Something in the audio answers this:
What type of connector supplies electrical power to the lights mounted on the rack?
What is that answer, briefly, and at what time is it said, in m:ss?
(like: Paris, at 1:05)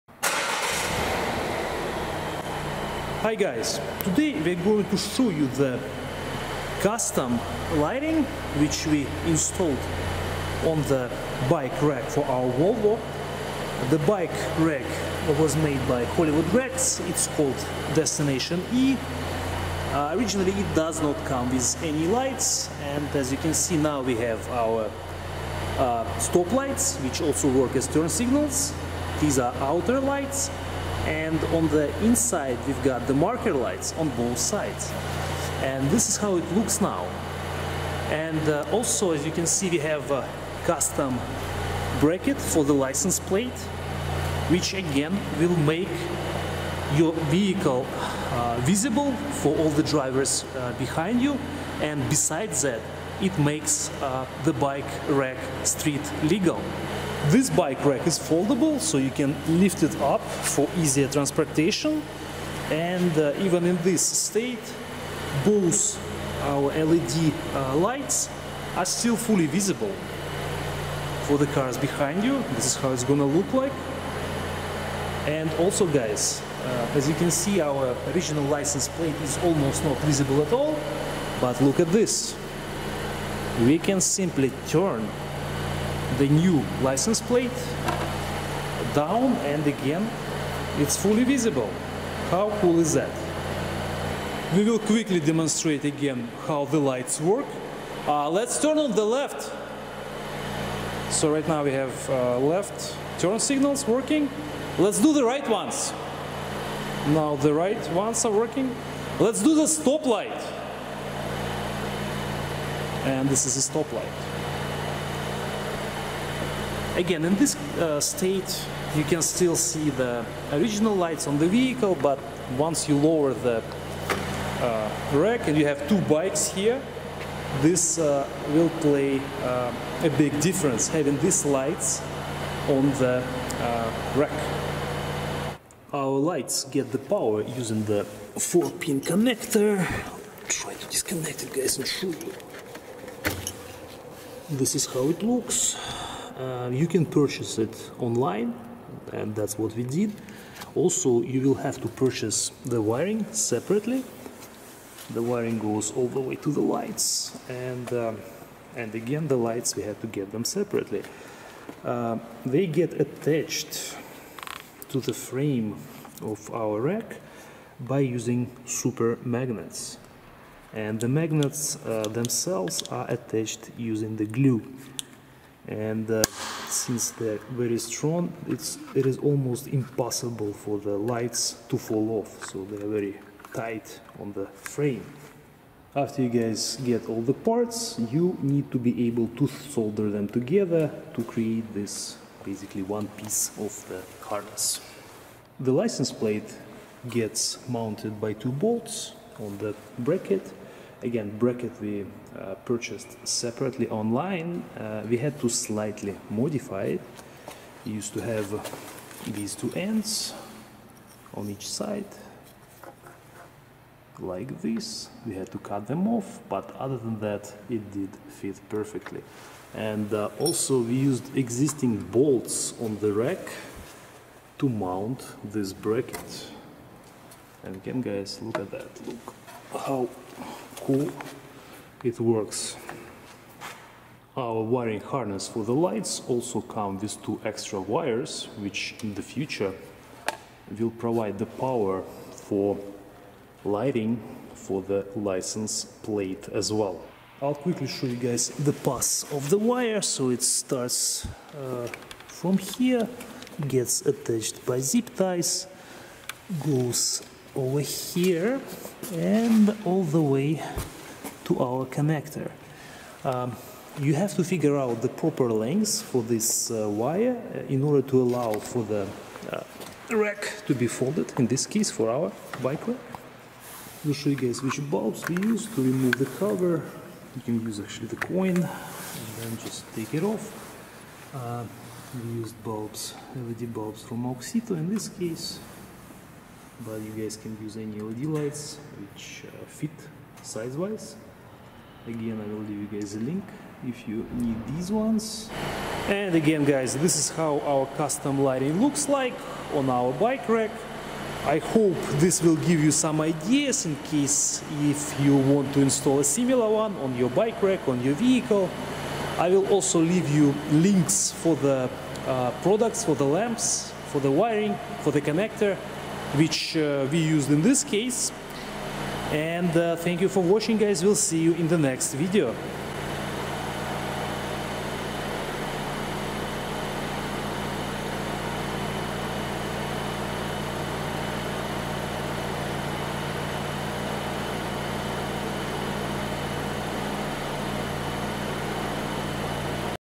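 4-pin connector, at 2:18.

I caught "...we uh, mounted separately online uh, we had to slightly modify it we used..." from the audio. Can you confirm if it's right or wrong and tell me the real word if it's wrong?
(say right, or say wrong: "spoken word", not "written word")
wrong: "purchased", not "mounted".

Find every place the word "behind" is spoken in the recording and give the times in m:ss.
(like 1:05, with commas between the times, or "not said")
0:50, 1:11.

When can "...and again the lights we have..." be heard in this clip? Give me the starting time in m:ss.
2:38.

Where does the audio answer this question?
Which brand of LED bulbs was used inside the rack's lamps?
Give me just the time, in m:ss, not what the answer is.
4:44.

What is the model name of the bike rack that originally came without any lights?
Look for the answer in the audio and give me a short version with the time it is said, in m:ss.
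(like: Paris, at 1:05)
Destination E, at 0:17.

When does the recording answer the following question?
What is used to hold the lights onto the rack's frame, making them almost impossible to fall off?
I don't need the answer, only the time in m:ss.
2:48.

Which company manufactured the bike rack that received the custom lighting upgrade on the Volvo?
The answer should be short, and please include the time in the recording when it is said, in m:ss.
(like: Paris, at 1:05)
Hollywood Racks, at 0:16.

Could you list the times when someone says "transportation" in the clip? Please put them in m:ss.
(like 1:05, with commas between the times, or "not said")
1:01.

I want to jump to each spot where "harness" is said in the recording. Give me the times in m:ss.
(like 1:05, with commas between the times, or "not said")
3:14, 3:55.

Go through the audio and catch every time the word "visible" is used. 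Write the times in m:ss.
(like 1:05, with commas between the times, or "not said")
0:48, 1:09, 1:19, 1:31.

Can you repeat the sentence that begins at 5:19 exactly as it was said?
And uh, thank you for watching guys, we'll see you in the next video.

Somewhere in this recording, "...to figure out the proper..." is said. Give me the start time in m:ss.
4:24.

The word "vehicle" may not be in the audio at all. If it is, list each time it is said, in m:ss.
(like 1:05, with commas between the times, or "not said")
0:47, 2:01, 5:08.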